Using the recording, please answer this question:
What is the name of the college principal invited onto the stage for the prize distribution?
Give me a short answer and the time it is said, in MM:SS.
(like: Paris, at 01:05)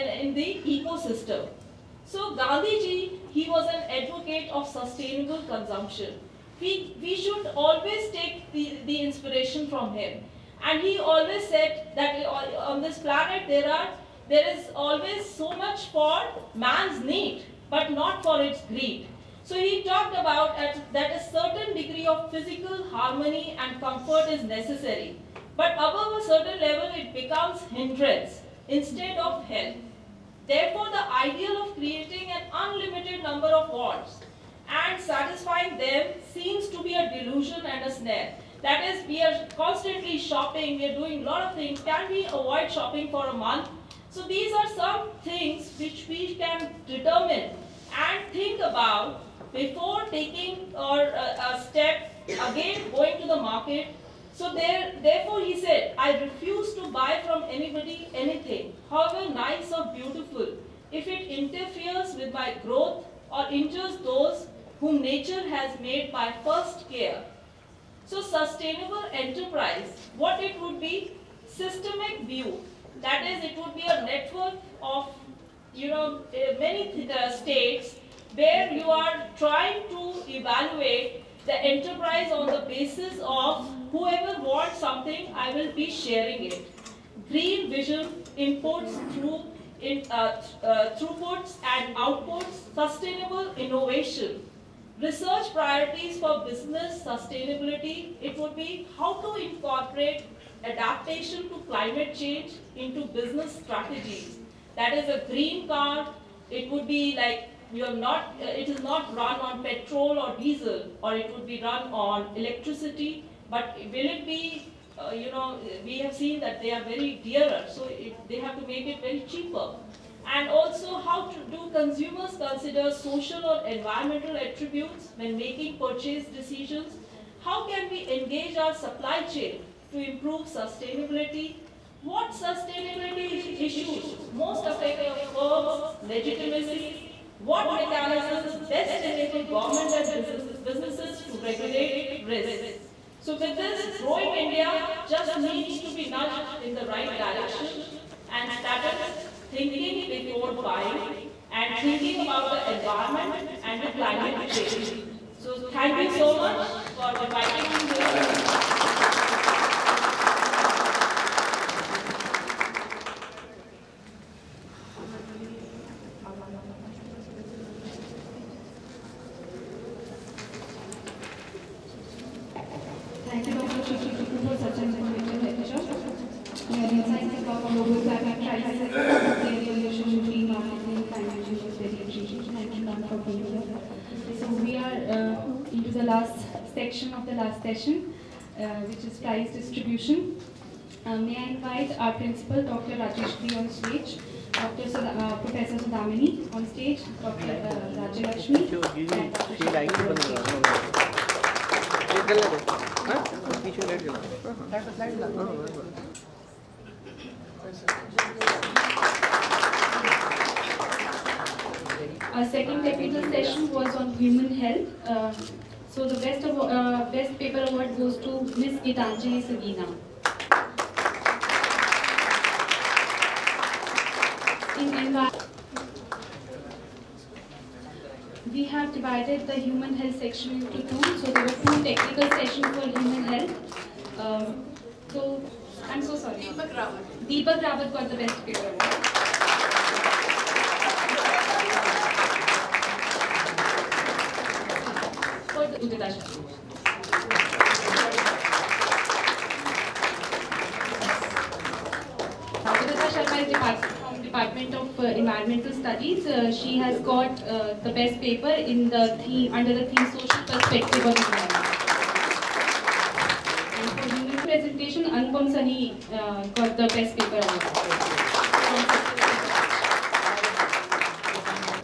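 Dr. Rajesh Dee, at 03:12.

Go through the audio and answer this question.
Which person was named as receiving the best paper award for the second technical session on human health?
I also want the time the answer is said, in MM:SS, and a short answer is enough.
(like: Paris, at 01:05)
Gitanjali Sagina, at 03:38.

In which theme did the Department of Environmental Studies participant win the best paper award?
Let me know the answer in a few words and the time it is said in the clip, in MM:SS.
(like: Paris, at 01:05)
Social Perspective of Environment, at 04:20.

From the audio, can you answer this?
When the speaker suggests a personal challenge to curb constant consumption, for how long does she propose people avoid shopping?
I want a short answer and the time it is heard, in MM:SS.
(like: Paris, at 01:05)
a month, at 00:43.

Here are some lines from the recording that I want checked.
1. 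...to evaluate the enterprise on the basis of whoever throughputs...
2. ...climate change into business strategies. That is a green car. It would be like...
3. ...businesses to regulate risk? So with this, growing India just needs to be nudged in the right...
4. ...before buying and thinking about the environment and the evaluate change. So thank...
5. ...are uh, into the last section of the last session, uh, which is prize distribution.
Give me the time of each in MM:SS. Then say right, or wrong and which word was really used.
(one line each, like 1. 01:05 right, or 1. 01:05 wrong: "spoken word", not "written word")
1. 01:19 wrong: "wants", not "throughputs"
2. 01:41 right
3. 02:20 right
4. 02:30 wrong: "climate", not "evaluate"
5. 03:04 right.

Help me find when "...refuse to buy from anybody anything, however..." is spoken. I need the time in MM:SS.
00:56.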